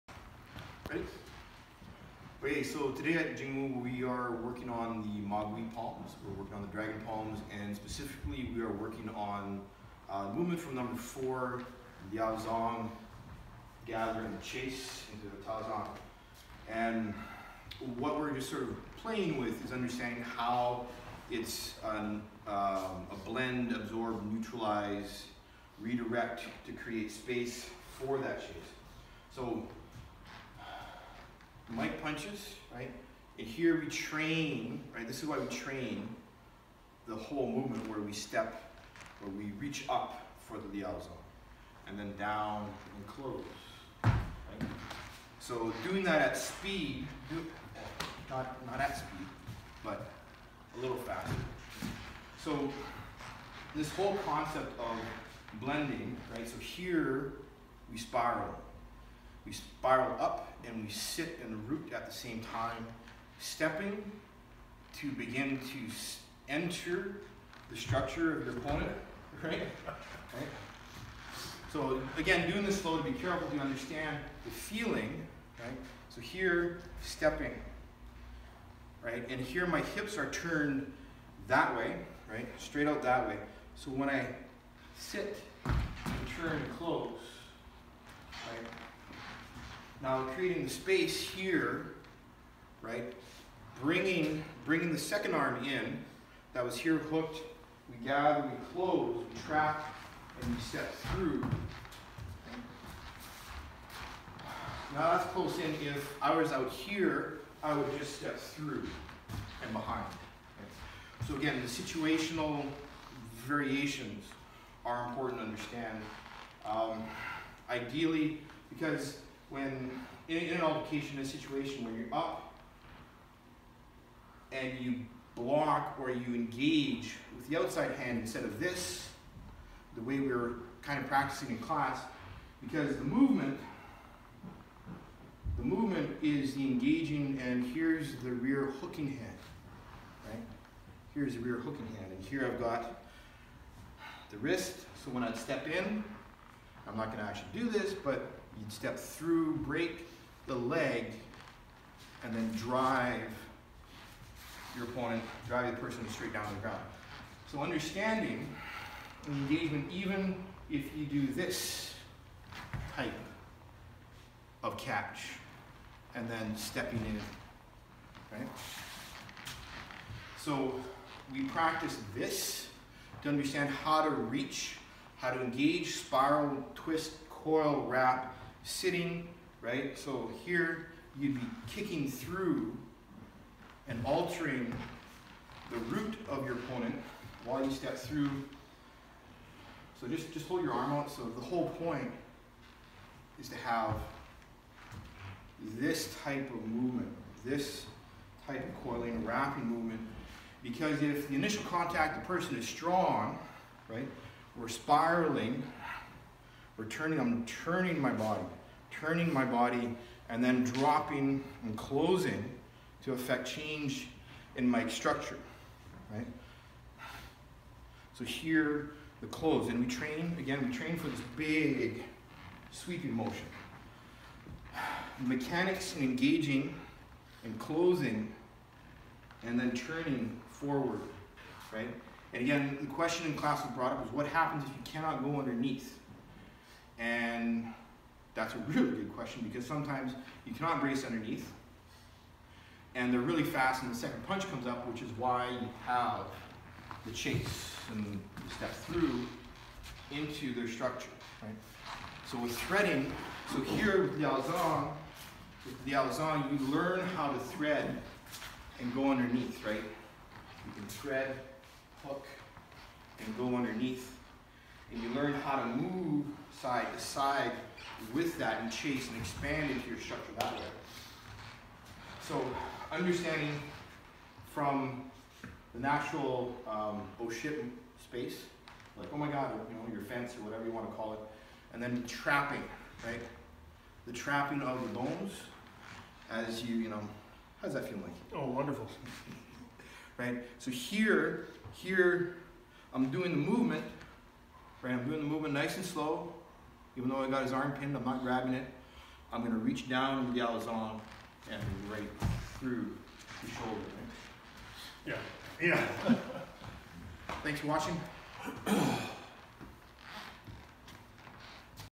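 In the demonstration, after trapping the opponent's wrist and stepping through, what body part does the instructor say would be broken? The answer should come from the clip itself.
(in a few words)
the leg.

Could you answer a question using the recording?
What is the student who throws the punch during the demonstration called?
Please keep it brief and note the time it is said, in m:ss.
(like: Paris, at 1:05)
Mike, at 0:31.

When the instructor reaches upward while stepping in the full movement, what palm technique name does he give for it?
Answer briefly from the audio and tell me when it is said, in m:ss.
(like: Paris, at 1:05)
liao zhang, at 0:40.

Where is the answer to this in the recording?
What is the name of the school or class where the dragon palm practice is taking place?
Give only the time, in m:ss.
0:03.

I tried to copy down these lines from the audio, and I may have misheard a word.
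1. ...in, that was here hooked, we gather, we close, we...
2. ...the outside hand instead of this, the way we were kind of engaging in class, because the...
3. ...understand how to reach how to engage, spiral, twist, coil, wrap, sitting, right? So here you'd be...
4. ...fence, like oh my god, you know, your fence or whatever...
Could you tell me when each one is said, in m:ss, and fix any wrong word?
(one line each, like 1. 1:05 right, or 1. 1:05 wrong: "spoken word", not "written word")
1. 1:35 right
2. 2:07 wrong: "practicing", not "engaging"
3. 2:53 right
4. 4:37 wrong: "space", not "fence".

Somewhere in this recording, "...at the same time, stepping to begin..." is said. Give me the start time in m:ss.
1:01.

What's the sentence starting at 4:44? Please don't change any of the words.
The trapping of the bones as you, you know, how's that feel like?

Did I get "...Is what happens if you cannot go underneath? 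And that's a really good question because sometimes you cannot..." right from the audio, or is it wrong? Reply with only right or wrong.
right.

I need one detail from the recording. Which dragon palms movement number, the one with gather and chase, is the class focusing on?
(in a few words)
4.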